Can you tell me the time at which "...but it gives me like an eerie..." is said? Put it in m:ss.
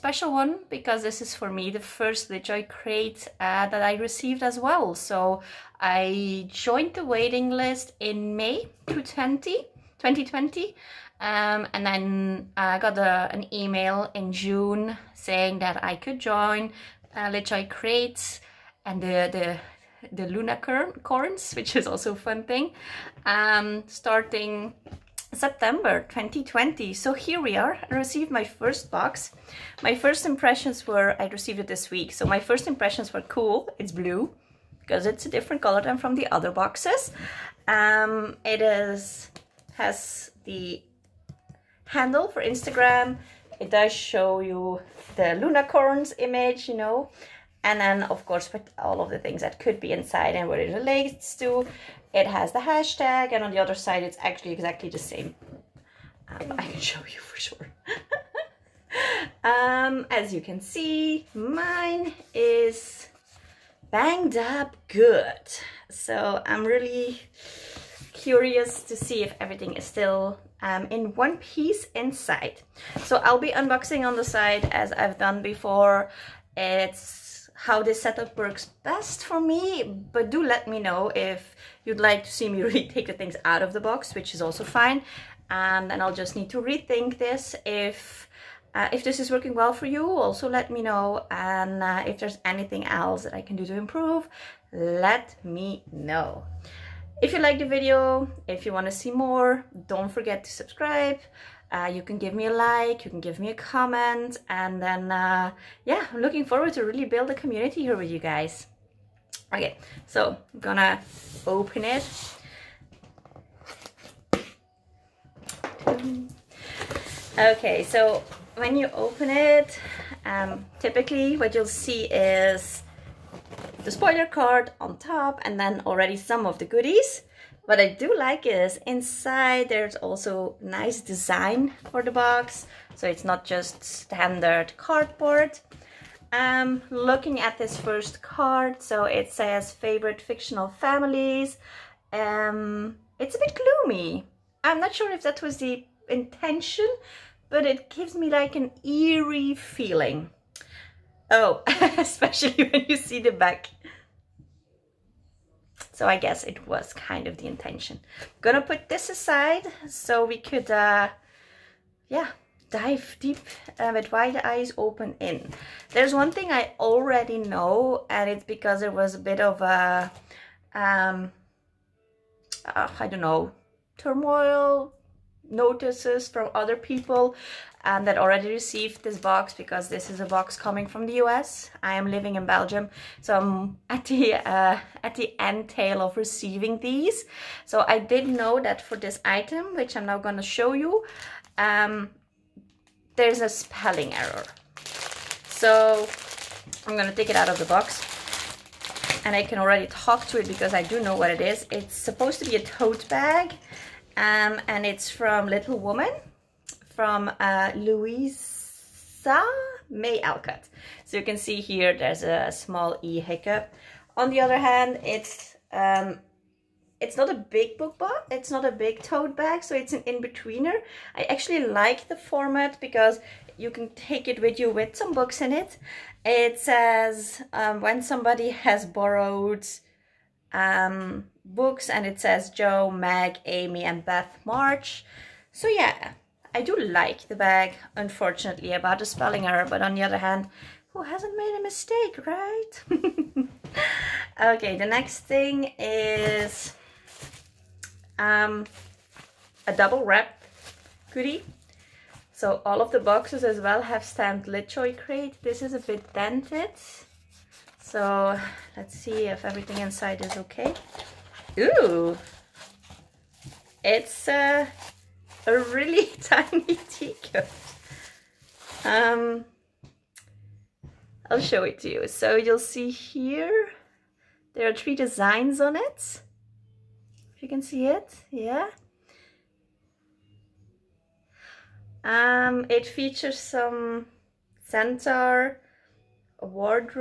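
2:27.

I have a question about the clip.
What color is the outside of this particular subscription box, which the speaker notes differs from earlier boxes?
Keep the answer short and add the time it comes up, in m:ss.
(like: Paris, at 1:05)
Blue, at 0:33.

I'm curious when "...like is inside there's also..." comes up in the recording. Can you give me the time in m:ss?
2:08.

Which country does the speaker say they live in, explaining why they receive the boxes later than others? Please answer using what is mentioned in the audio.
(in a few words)
Belgium.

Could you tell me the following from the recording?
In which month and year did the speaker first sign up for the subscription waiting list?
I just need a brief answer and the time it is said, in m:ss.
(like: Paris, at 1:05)
May 2020, at 0:08.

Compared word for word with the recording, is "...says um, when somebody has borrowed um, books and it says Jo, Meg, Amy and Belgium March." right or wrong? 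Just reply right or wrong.
wrong.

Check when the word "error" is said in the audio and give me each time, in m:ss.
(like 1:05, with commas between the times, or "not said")
3:14, 3:59.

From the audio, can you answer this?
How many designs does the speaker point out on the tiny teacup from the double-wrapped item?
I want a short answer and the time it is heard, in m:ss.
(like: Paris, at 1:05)
3, at 4:34.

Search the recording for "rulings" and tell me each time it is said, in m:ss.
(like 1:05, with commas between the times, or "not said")
not said.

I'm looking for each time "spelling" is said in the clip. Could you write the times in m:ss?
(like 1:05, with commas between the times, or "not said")
3:13, 3:59.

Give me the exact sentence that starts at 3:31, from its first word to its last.
So you can see here there's a small E hiccup.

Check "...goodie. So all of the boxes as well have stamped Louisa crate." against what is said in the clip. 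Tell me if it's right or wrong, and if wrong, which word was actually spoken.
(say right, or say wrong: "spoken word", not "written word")
wrong: "LitJoy", not "Louisa".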